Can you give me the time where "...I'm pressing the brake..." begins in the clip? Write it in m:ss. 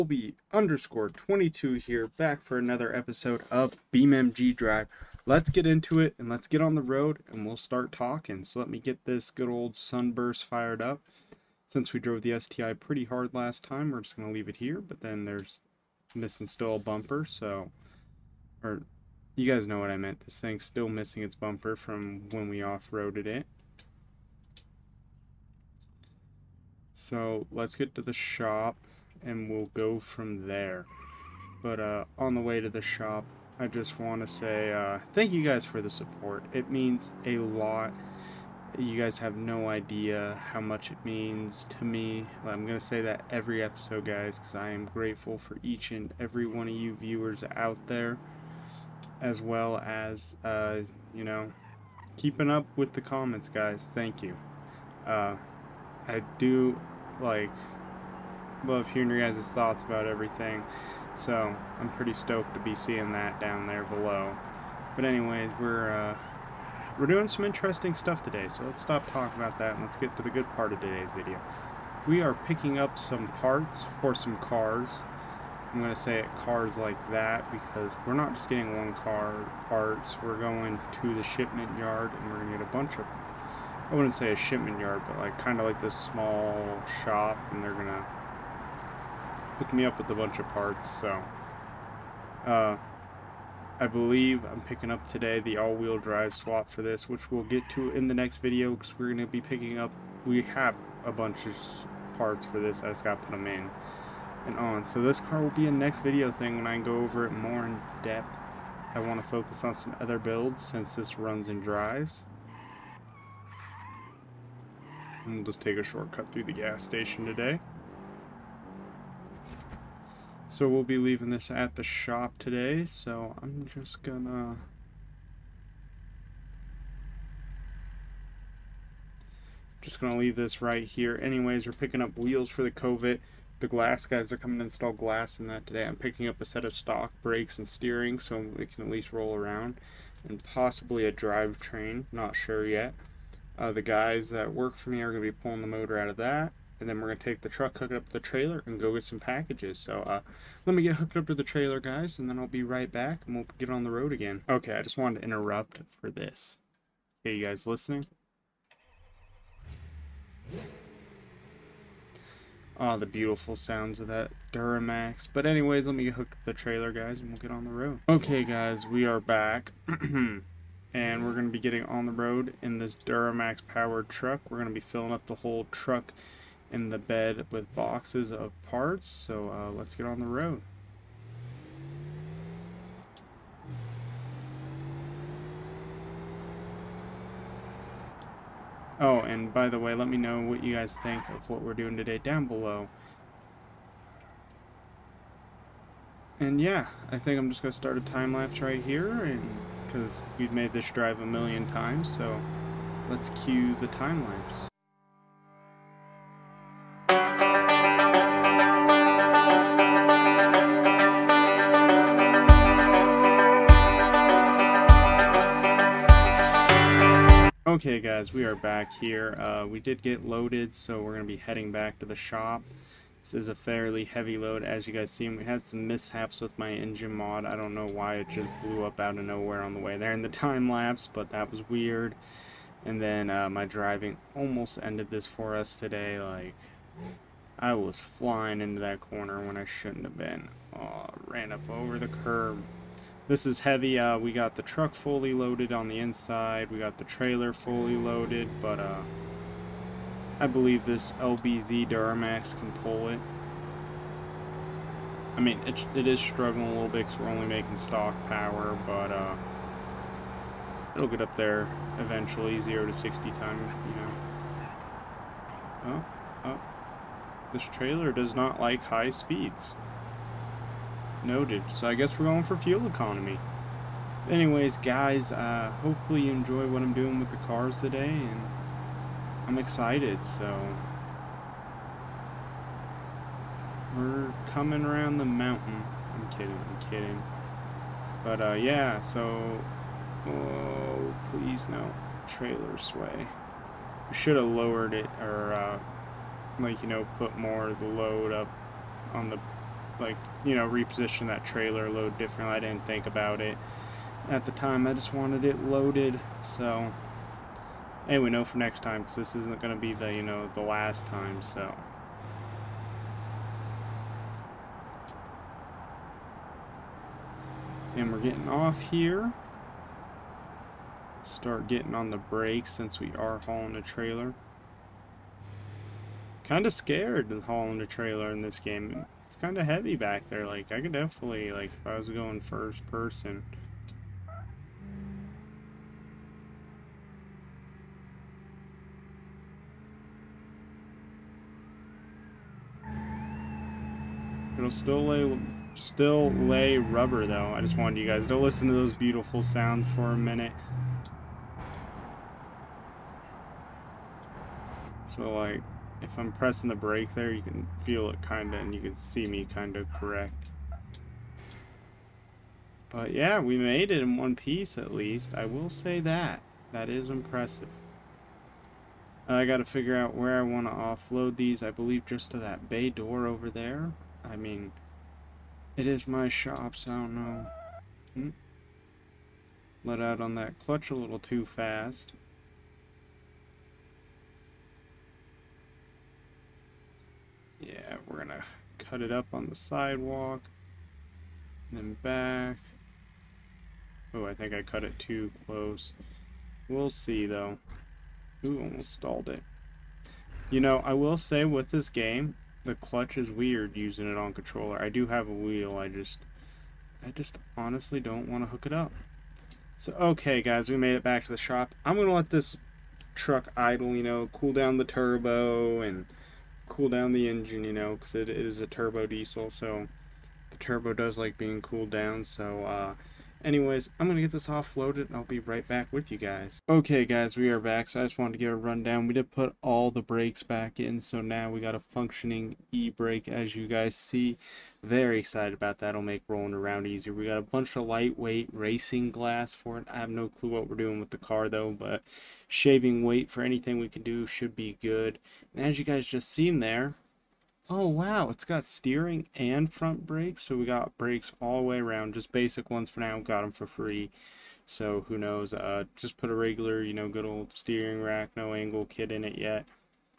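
5:56.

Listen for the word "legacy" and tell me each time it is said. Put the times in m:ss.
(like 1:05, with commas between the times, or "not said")
not said.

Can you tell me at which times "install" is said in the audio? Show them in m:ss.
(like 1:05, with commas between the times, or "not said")
2:14.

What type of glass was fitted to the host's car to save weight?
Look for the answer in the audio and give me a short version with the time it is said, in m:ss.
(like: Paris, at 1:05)
lightweight racing glass, at 7:17.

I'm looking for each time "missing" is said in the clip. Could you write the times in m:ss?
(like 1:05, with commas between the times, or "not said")
0:16, 0:20.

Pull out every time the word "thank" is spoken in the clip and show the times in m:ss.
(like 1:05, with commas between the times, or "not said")
0:35, 0:53.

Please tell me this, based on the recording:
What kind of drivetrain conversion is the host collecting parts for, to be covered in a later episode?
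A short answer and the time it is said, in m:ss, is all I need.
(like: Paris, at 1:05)
all-wheel drive swap, at 1:35.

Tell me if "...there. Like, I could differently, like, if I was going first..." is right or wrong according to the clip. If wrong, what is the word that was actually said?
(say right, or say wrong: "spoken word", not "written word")
wrong: "definitely", not "differently".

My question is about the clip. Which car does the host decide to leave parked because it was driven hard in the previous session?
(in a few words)
STI.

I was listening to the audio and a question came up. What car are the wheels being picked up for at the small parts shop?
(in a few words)
Covet.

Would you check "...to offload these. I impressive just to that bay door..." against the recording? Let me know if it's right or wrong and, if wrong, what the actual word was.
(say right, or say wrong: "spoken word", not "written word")
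wrong: "believe", not "impressive".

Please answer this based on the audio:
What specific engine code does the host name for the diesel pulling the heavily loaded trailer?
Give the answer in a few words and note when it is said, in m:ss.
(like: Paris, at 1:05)
LBZ Duramax, at 4:11.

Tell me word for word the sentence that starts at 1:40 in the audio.
We have a bunch of parts for this, I just gotta put them in and on.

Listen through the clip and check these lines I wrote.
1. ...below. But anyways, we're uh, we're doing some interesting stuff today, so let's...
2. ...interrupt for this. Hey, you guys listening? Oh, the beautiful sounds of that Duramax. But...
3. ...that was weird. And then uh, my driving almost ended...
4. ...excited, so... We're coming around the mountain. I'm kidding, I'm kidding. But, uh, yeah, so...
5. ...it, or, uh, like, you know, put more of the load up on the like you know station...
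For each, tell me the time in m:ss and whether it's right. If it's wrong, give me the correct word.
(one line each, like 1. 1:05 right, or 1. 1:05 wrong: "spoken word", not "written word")
1. 1:03 right
2. 2:35 right
3. 3:51 right
4. 4:39 right
5. 4:54 wrong: "reposition", not "station".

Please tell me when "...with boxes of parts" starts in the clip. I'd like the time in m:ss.
2:57.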